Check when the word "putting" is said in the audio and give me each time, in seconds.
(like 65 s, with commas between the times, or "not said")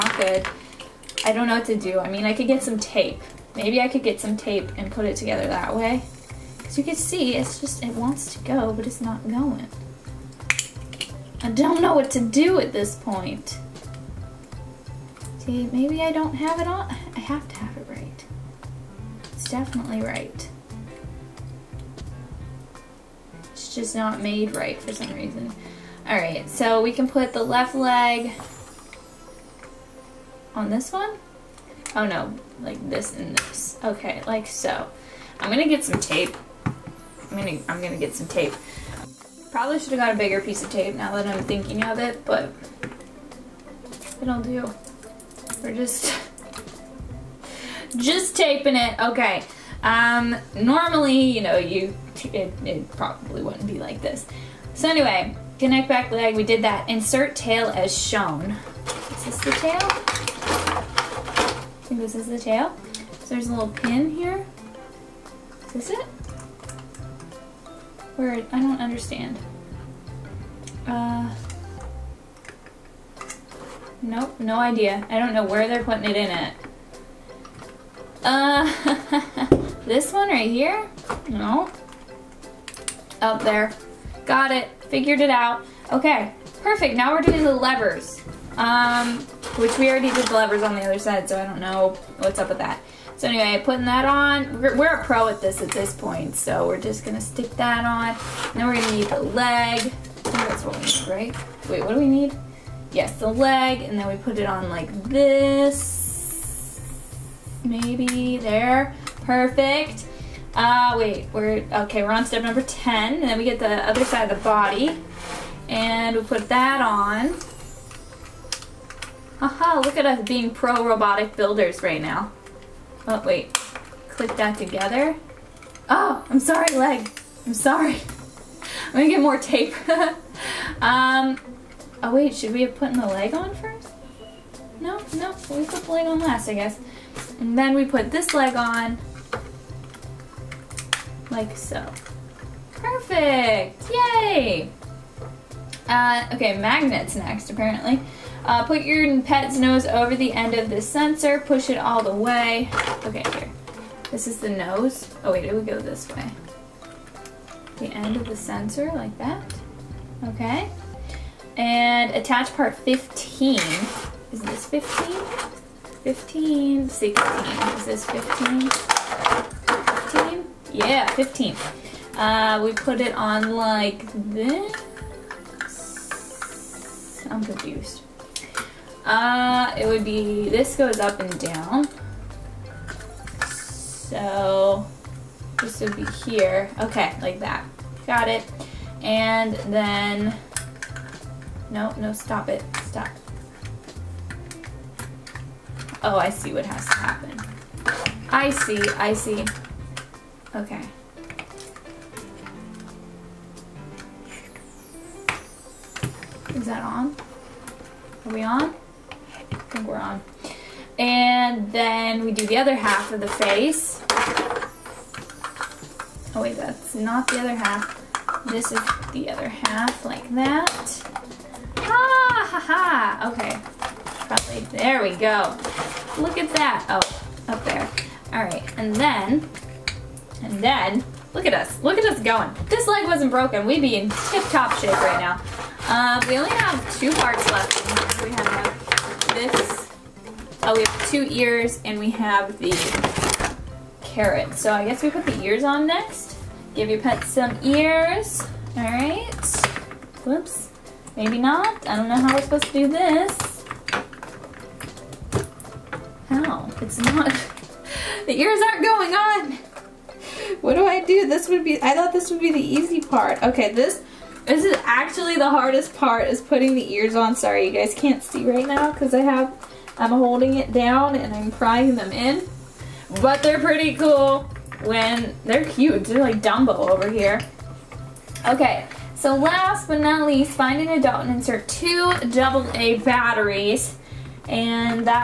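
75 s, 93 s, 266 s.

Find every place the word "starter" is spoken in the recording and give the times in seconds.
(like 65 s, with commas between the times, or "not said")
not said.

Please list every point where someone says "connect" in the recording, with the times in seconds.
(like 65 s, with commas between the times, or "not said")
55 s.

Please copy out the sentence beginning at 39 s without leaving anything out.
Probably should have got a bigger piece of tape now that I'm thinking of it, but it'll do.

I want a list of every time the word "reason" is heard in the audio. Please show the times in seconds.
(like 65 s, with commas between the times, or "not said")
25 s.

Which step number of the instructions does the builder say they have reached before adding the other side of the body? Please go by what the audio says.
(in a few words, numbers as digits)
10.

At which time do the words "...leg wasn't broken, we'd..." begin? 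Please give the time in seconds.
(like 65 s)
232 s.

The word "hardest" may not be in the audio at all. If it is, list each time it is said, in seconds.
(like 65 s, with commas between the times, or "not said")
265 s.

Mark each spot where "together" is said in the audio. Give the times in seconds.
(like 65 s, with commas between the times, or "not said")
5 s, 124 s.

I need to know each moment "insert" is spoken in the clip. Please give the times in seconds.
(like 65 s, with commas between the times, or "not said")
56 s, 281 s.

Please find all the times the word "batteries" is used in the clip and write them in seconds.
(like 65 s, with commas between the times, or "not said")
283 s.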